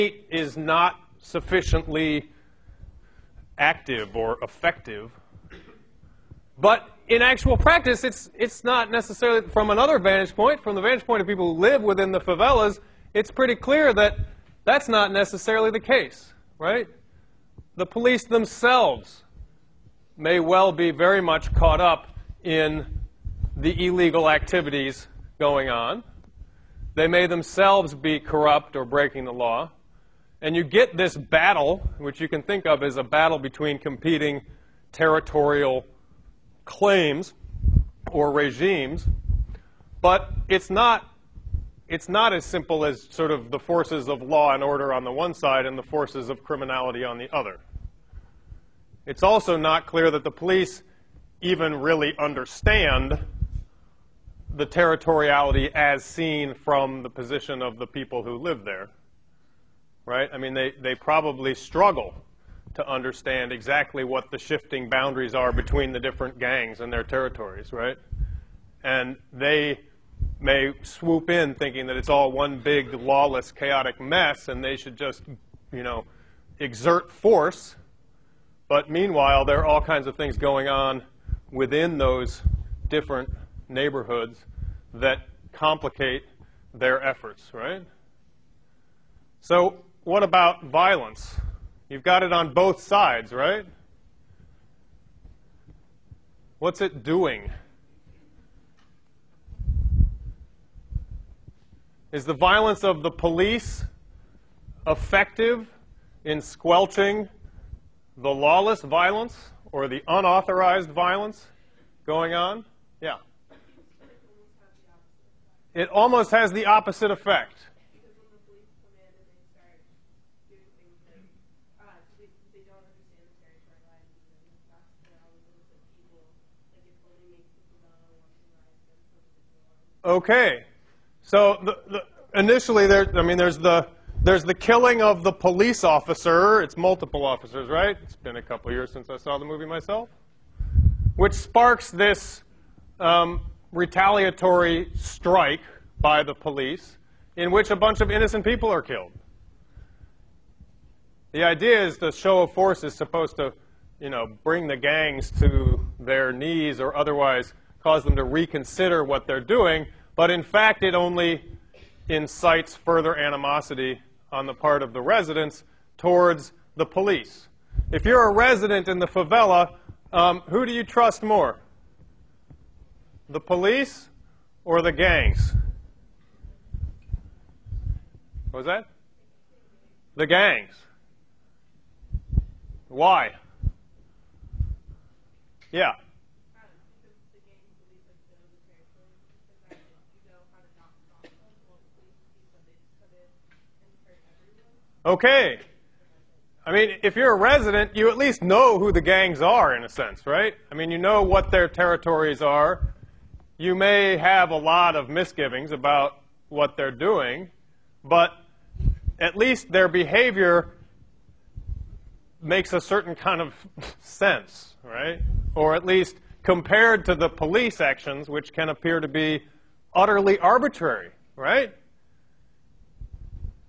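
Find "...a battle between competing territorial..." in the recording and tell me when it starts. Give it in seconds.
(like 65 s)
32 s.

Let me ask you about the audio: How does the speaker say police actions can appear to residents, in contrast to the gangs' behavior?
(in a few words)
utterly arbitrary.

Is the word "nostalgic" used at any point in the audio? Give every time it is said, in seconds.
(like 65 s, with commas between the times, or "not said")
not said.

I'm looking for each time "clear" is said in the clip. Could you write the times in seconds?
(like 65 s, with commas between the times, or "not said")
13 s, 49 s.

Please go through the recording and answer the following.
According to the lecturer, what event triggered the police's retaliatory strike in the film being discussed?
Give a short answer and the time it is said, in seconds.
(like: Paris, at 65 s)
killing of the police officer, at 134 s.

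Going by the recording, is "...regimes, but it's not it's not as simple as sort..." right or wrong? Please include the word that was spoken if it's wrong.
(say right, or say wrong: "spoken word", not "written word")
right.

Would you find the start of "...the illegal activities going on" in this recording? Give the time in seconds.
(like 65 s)
23 s.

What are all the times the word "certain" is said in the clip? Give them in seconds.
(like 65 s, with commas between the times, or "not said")
212 s.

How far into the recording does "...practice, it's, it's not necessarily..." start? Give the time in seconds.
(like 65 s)
7 s.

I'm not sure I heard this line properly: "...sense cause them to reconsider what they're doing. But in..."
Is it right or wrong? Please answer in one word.
wrong.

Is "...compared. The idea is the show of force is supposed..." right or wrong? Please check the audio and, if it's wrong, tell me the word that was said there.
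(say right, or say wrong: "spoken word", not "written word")
wrong: "killed", not "compared".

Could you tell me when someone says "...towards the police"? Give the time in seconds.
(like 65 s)
165 s.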